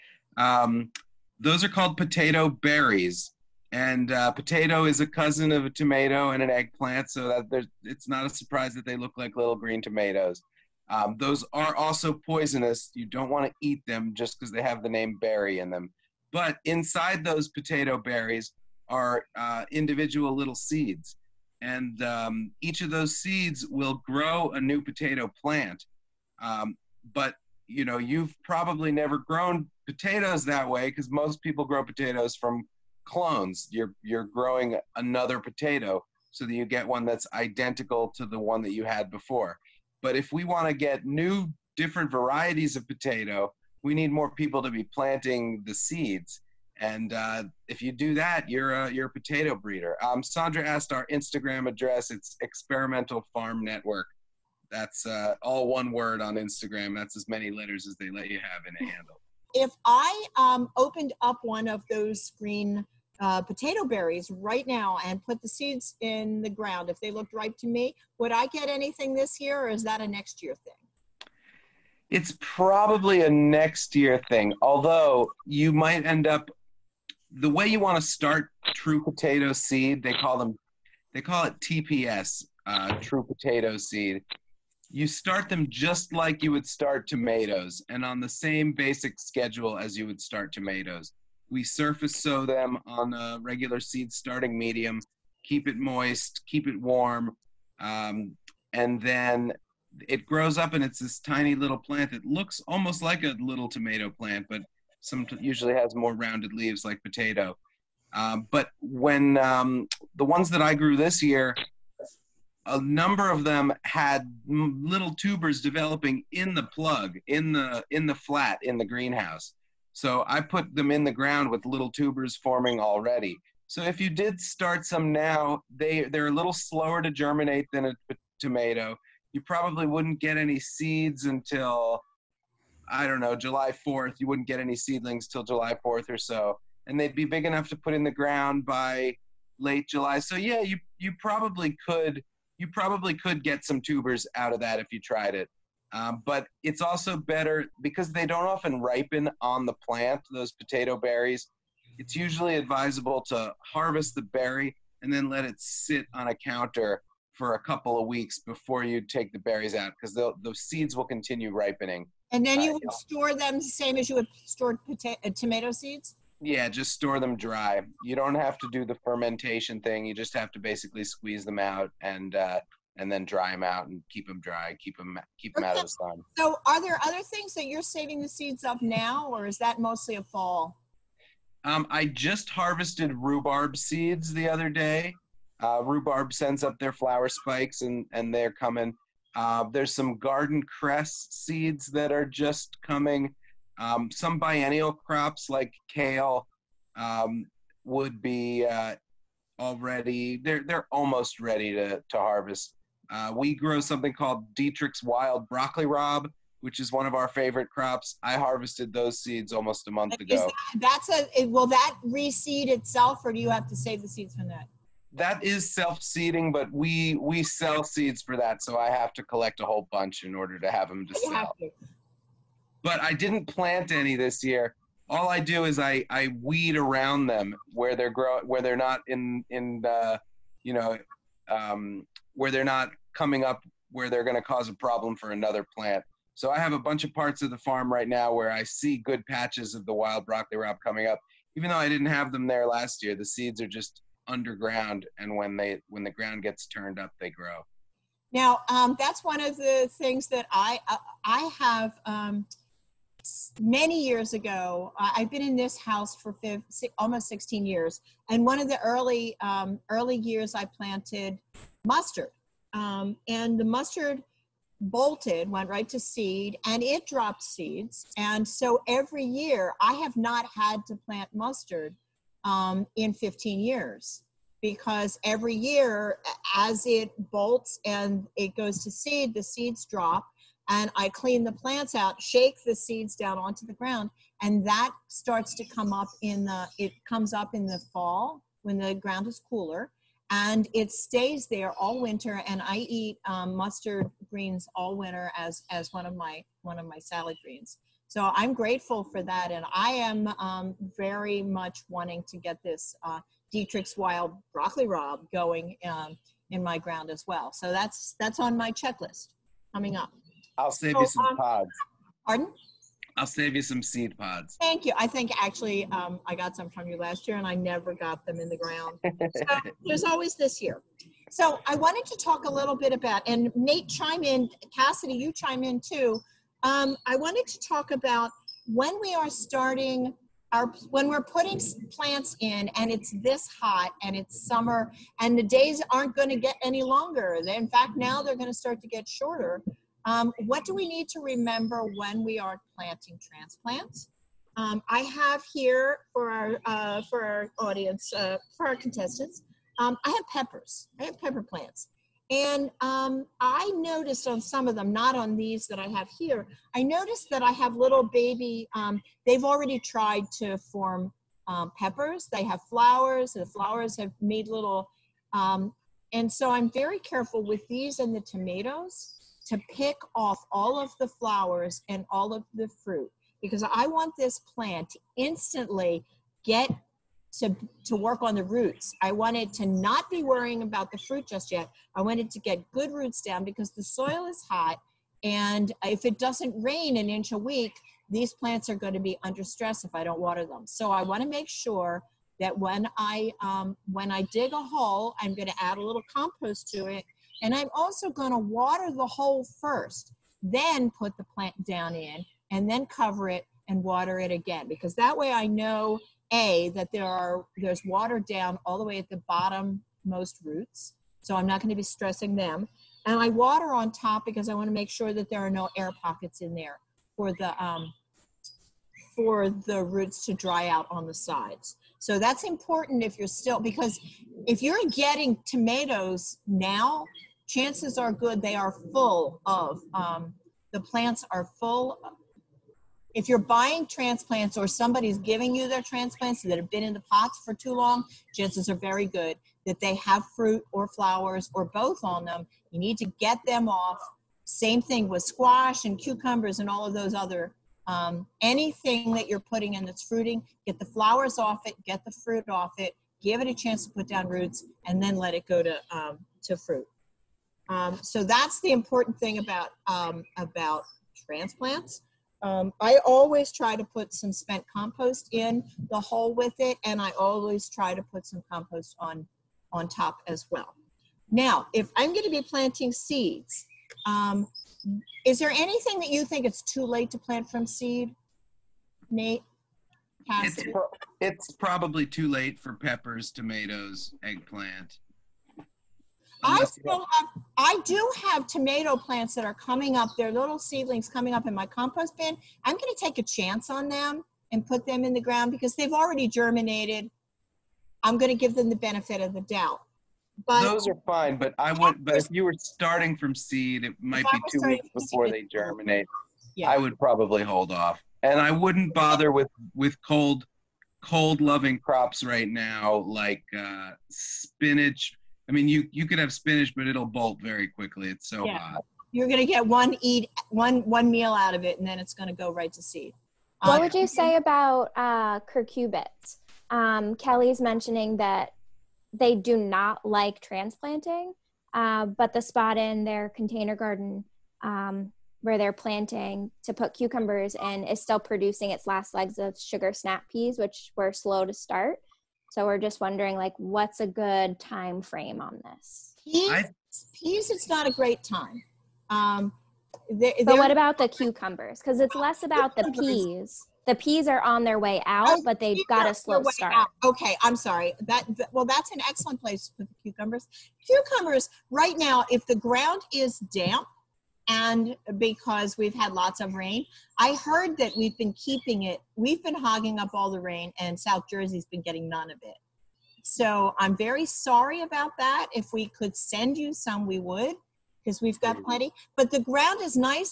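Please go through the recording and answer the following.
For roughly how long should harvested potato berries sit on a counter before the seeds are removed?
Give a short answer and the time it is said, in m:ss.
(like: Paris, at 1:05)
a couple of weeks, at 2:37.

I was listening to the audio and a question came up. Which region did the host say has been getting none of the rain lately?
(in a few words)
South Jersey.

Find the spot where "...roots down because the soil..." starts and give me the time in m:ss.
6:22.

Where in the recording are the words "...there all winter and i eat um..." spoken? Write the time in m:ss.
4:51.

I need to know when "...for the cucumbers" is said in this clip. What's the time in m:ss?
9:19.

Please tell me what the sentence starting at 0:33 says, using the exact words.
You're you're growing another potato so that you get one that's identical to the one that you had before.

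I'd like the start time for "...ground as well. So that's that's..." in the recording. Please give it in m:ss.
5:06.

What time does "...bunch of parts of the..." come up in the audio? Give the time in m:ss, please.
3:56.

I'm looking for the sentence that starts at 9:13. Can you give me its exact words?
The peas are on their way out, oh, but they've got a slow start.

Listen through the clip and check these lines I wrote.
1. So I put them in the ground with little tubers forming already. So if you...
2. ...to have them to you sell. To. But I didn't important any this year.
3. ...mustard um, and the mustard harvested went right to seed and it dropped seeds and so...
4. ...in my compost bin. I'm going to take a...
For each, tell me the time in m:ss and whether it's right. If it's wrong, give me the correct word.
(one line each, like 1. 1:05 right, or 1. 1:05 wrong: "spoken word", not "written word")
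1. 1:59 right
2. 3:40 wrong: "plant", not "important"
3. 4:21 wrong: "bolted", not "harvested"
4. 8:11 right.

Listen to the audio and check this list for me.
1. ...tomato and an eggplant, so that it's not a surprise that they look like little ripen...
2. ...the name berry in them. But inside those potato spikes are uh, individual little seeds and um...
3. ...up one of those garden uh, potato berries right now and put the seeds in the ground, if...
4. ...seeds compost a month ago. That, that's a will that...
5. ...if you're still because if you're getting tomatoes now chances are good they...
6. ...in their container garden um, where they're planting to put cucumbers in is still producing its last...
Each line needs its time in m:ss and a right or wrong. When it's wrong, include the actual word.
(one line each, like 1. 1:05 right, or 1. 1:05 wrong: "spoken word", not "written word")
1. 0:05 wrong: "green", not "ripen"
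2. 0:14 wrong: "berries", not "spikes"
3. 1:01 wrong: "green", not "garden"
4. 3:29 wrong: "almost", not "compost"
5. 7:03 right
6. 8:52 right.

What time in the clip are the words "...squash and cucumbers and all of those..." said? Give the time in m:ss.
7:25.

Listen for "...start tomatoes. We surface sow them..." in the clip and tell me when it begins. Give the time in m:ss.
1:30.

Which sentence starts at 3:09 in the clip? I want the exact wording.
Uh, there's some garden cress seeds that are just coming.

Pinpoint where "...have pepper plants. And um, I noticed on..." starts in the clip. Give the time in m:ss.
5:51.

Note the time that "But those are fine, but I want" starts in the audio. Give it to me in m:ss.
8:20.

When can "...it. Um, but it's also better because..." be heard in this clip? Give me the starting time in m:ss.
2:25.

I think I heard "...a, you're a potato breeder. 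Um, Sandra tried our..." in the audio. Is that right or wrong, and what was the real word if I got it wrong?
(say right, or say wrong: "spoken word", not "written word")
wrong: "asked", not "tried".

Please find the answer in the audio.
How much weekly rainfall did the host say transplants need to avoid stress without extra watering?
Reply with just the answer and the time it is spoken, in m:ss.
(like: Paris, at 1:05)
an inch a week, at 6:26.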